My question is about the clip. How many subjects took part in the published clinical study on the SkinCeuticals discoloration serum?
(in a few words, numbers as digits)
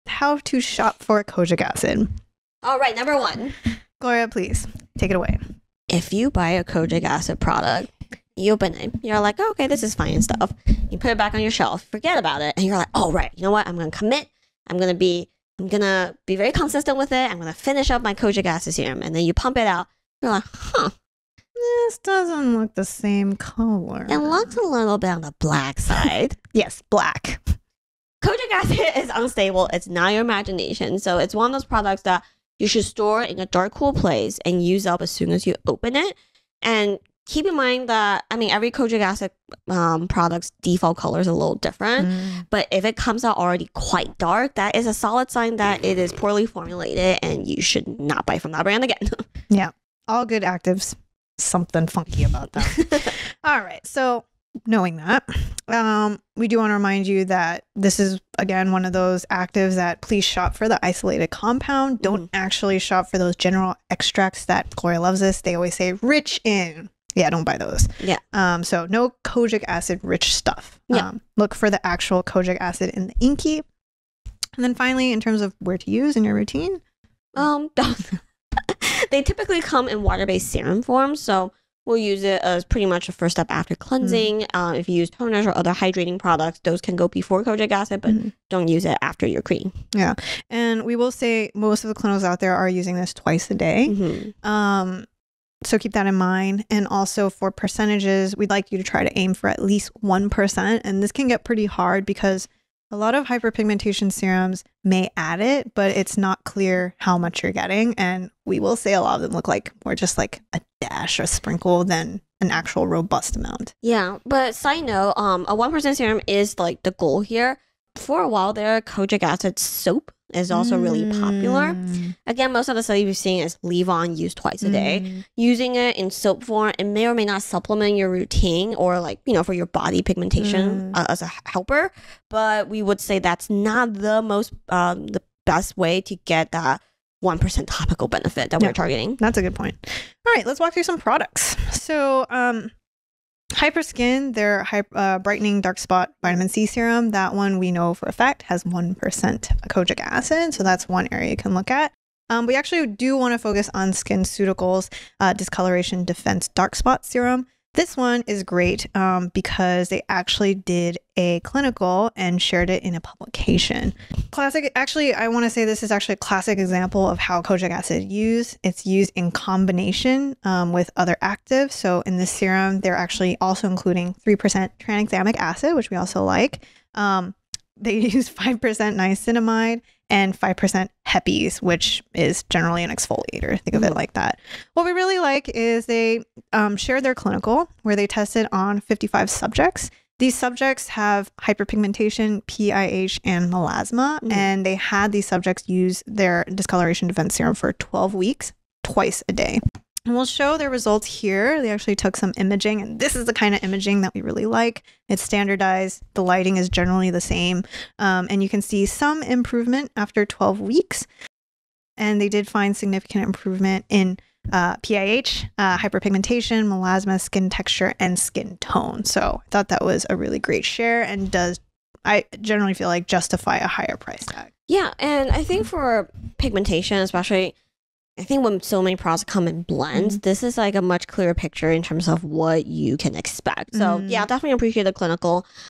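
55.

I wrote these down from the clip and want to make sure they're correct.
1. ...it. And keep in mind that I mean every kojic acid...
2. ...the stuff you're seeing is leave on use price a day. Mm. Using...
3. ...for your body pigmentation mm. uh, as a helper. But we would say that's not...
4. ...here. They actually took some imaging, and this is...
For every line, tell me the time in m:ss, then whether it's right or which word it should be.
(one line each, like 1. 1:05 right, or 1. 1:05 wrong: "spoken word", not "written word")
1. 0:35 right
2. 2:02 wrong: "twice", not "price"
3. 2:09 right
4. 3:21 right.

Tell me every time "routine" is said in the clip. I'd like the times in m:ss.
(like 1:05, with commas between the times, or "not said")
1:16, 2:08.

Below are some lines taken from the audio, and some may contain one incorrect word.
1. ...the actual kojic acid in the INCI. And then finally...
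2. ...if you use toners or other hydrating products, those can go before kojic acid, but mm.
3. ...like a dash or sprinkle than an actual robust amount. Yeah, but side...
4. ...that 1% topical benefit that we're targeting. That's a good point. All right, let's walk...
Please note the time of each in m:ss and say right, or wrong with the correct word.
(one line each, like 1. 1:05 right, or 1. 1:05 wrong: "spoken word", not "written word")
1. 1:11 right
2. 1:24 right
3. 1:50 right
4. 2:16 right.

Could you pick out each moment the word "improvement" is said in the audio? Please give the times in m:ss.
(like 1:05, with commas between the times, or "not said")
3:29, 3:33.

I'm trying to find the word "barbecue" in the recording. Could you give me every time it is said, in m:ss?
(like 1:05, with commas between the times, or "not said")
not said.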